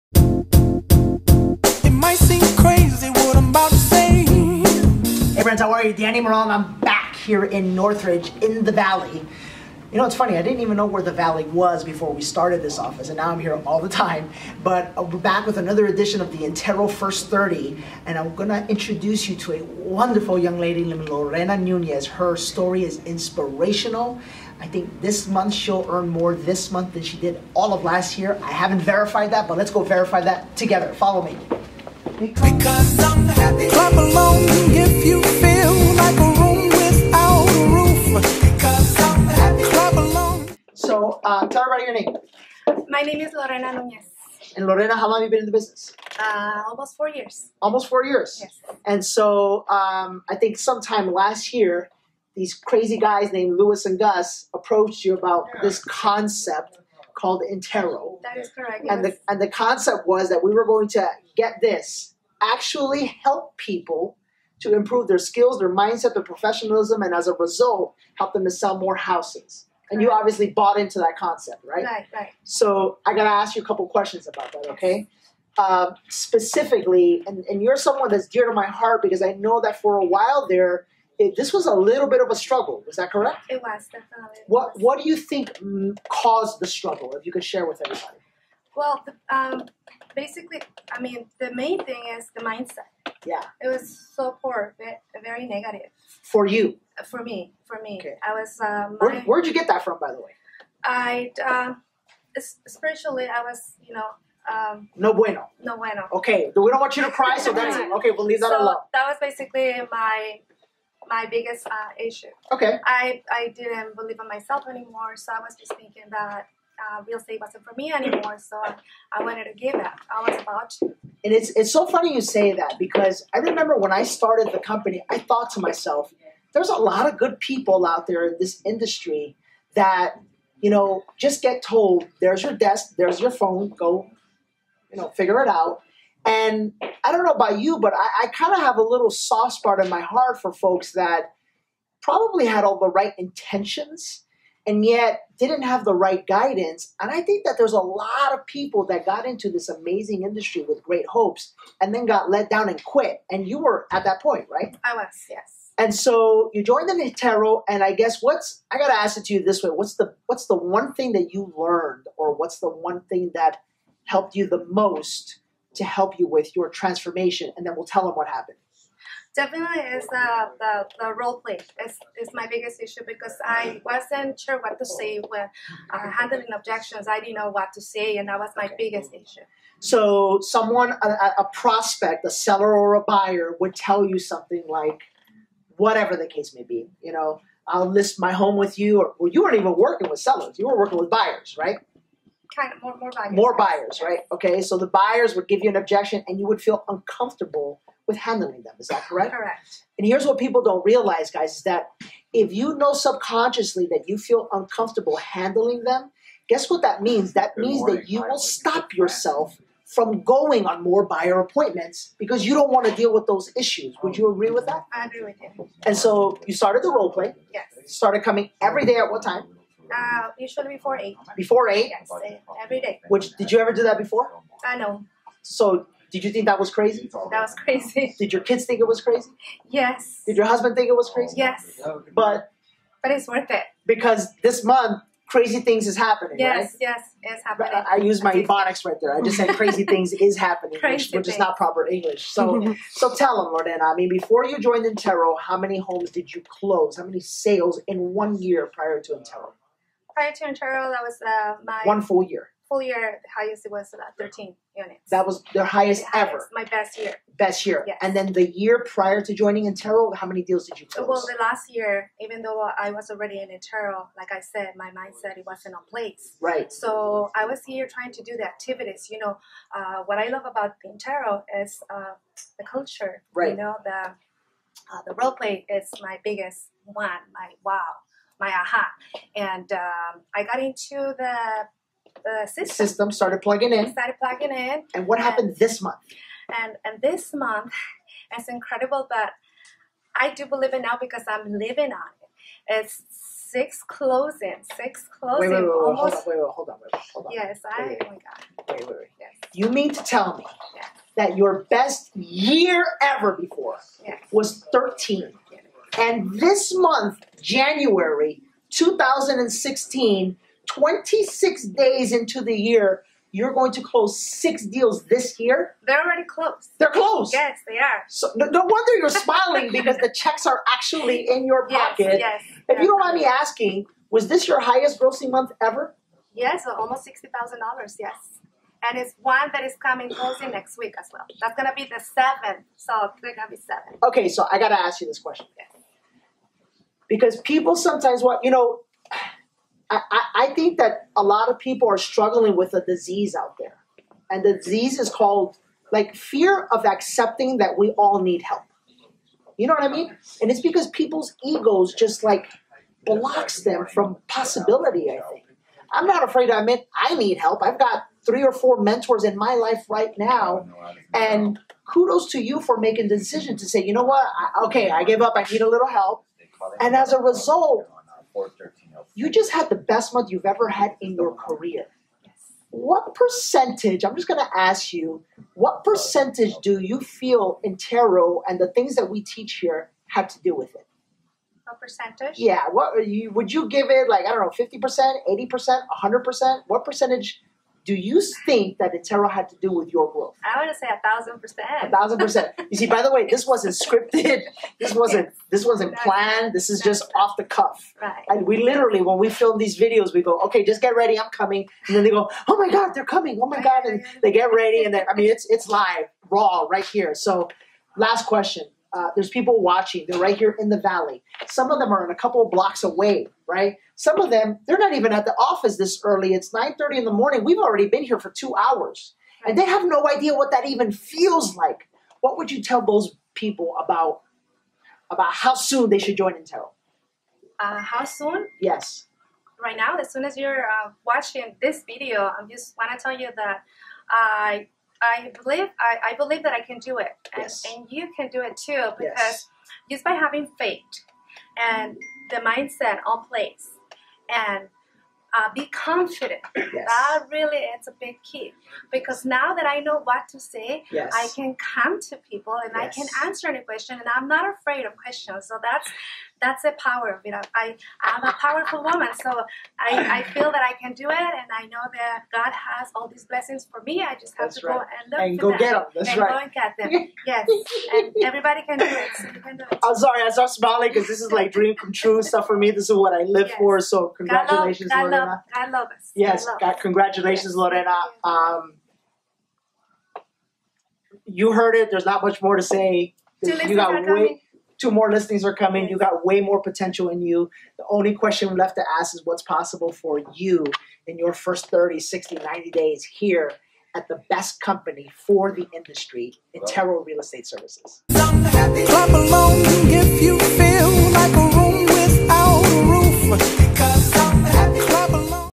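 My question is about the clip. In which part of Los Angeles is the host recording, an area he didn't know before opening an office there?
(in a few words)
Northridge.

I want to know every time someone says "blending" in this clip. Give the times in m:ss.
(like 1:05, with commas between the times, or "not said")
not said.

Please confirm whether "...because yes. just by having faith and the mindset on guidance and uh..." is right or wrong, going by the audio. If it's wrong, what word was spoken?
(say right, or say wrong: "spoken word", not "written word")
wrong: "place", not "guidance".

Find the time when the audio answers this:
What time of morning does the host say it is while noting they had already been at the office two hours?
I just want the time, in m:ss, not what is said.
6:56.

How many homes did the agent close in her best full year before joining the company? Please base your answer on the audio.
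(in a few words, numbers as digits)
13.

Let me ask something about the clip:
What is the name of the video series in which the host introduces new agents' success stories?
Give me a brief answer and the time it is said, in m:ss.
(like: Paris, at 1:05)
Intero First 30, at 0:16.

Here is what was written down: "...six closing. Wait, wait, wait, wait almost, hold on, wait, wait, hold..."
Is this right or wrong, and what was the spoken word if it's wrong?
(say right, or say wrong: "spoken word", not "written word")
right.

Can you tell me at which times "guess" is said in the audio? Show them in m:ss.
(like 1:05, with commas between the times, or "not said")
2:37, 3:26.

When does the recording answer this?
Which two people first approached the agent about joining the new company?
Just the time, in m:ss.
0:53.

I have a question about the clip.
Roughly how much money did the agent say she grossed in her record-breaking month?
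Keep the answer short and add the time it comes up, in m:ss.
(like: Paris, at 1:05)
almost $60,000, at 5:26.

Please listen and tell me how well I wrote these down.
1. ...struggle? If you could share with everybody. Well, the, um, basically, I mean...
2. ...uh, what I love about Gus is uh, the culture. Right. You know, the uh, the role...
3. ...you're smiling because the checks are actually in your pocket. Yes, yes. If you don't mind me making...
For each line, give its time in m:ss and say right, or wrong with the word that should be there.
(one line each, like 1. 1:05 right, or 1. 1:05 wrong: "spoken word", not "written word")
1. 1:26 right
2. 4:29 wrong: "Intero", not "Gus"
3. 5:18 wrong: "asking", not "making".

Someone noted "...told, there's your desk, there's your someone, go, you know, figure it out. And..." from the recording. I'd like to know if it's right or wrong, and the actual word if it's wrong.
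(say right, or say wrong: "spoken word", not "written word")
wrong: "phone", not "someone".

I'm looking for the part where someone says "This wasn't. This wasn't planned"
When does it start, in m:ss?
6:34.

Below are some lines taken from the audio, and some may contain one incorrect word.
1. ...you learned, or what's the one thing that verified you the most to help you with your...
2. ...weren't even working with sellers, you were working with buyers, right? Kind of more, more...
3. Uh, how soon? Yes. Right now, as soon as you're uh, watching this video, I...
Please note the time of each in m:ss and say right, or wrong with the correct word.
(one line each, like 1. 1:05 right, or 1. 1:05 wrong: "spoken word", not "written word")
1. 2:41 wrong: "helped", not "verified"
2. 3:09 right
3. 7:07 right.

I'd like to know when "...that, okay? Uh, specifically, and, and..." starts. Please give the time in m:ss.
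1:14.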